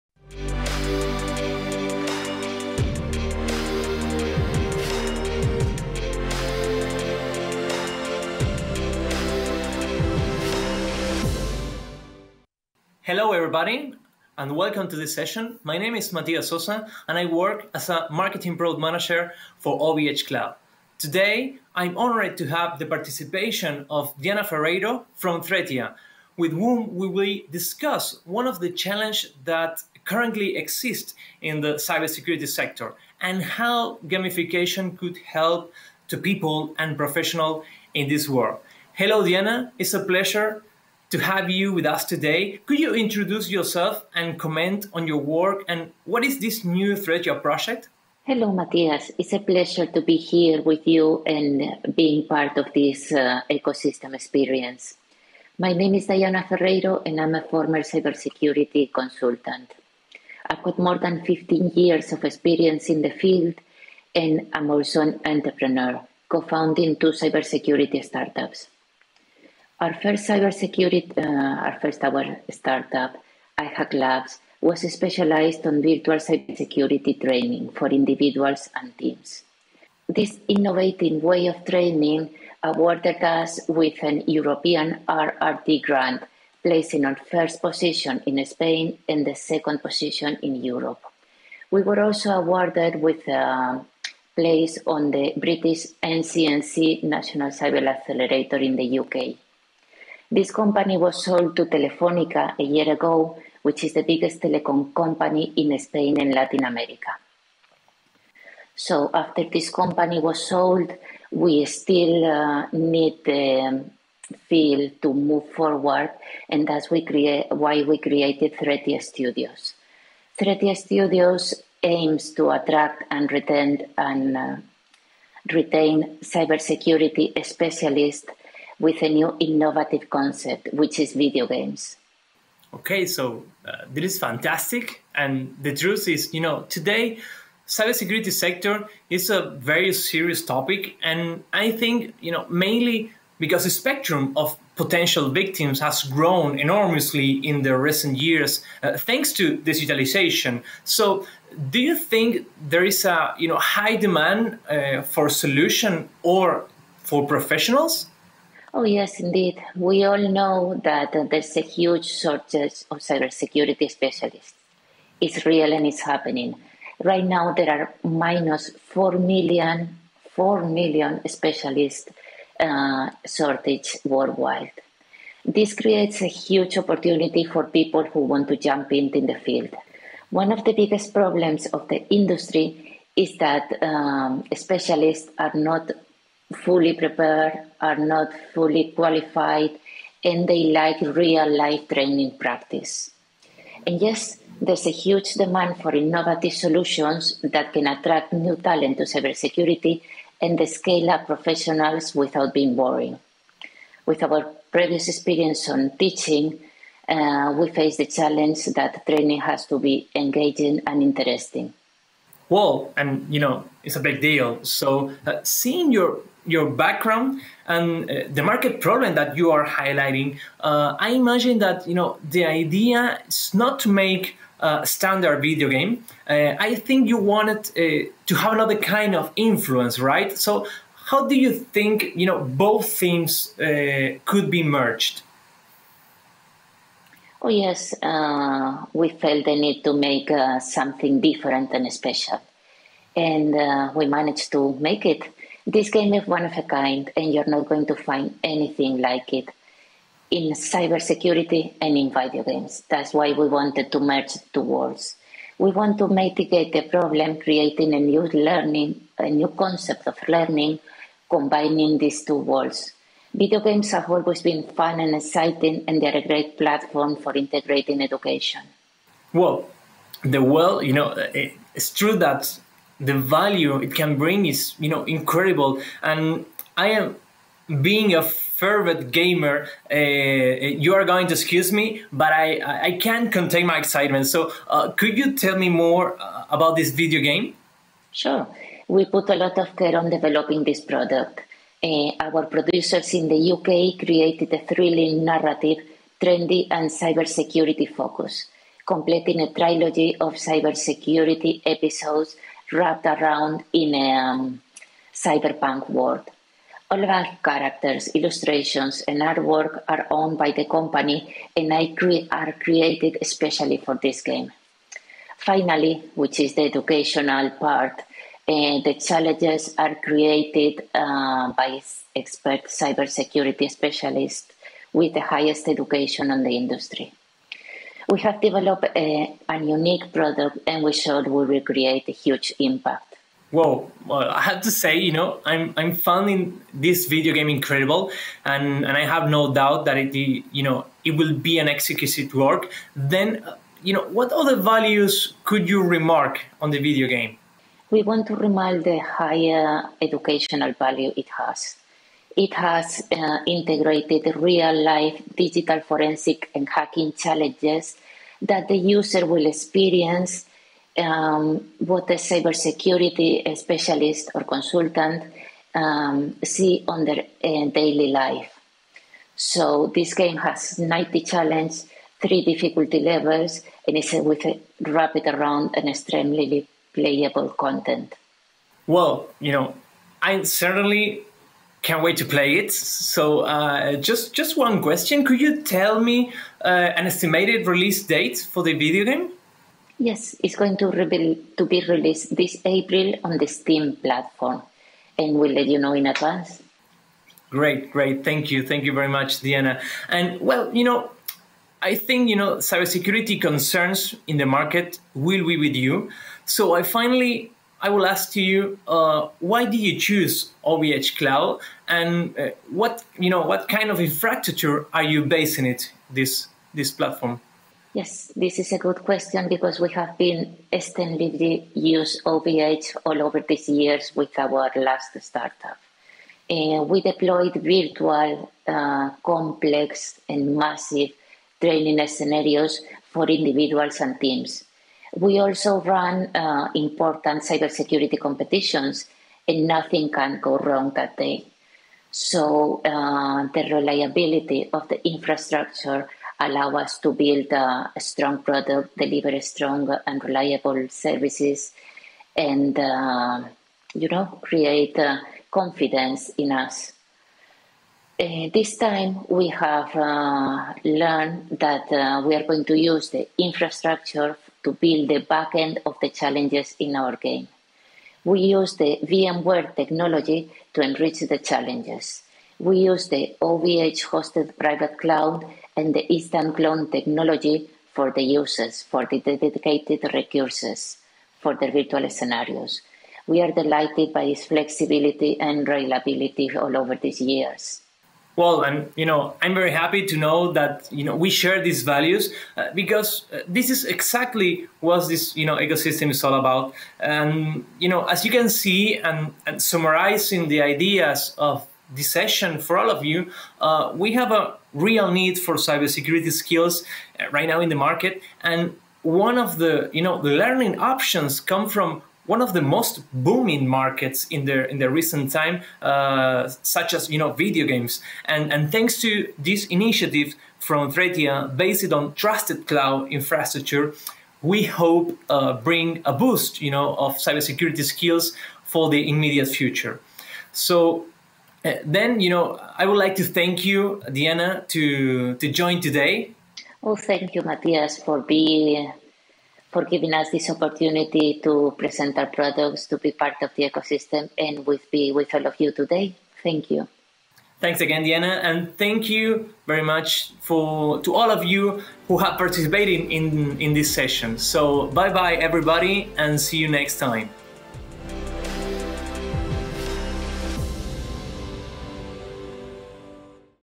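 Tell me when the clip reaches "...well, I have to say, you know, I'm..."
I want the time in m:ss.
5:34.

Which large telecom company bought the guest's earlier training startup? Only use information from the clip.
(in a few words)
Telefónica.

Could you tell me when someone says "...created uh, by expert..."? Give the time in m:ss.
5:20.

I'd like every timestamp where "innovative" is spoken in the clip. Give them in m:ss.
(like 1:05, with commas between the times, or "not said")
1:20, 2:09, 3:15.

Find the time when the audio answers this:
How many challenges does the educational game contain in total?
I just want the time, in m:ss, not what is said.
6:10.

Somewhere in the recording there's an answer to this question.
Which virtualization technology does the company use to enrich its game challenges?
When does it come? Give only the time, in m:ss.
7:49.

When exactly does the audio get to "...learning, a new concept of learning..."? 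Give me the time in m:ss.
4:18.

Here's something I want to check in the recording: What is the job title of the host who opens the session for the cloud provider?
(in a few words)
Marketing product manager.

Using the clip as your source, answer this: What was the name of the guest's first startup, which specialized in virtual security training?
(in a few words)
iHack Labs.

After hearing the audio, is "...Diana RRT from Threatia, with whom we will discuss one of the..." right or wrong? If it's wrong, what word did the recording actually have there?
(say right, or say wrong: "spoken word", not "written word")
wrong: "Ferreiro", not "RRT".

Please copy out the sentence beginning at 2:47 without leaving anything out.
Right now, there are minus 4 million, 4 million specialists uh, shortage worldwide.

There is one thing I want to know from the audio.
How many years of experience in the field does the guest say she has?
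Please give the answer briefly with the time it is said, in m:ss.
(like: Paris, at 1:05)
15, at 1:01.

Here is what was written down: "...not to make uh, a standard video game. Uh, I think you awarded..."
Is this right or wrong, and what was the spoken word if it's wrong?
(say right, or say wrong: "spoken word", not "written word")
wrong: "wanted", not "awarded".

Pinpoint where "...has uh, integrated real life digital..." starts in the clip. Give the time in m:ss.
5:52.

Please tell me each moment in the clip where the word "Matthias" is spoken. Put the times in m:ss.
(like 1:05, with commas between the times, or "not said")
0:48, 8:57.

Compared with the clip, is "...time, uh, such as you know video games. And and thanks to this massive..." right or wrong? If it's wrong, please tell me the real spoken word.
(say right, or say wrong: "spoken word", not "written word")
wrong: "initiative", not "massive".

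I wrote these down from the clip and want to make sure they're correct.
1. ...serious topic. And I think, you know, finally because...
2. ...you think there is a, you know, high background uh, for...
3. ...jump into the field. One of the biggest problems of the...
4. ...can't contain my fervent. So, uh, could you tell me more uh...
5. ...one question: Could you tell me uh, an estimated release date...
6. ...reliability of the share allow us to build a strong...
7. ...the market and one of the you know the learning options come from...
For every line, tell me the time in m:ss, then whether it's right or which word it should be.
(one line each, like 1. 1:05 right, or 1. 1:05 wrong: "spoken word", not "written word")
1. 2:19 wrong: "mainly", not "finally"
2. 2:31 wrong: "demand", not "background"
3. 2:58 right
4. 4:43 wrong: "excitement", not "fervent"
5. 6:24 right
6. 7:23 wrong: "infrastructure", not "share"
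7. 8:27 right.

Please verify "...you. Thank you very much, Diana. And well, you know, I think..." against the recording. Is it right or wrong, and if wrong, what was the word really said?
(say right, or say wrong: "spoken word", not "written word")
right.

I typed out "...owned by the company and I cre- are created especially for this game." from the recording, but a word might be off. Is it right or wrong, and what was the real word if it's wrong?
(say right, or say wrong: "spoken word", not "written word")
right.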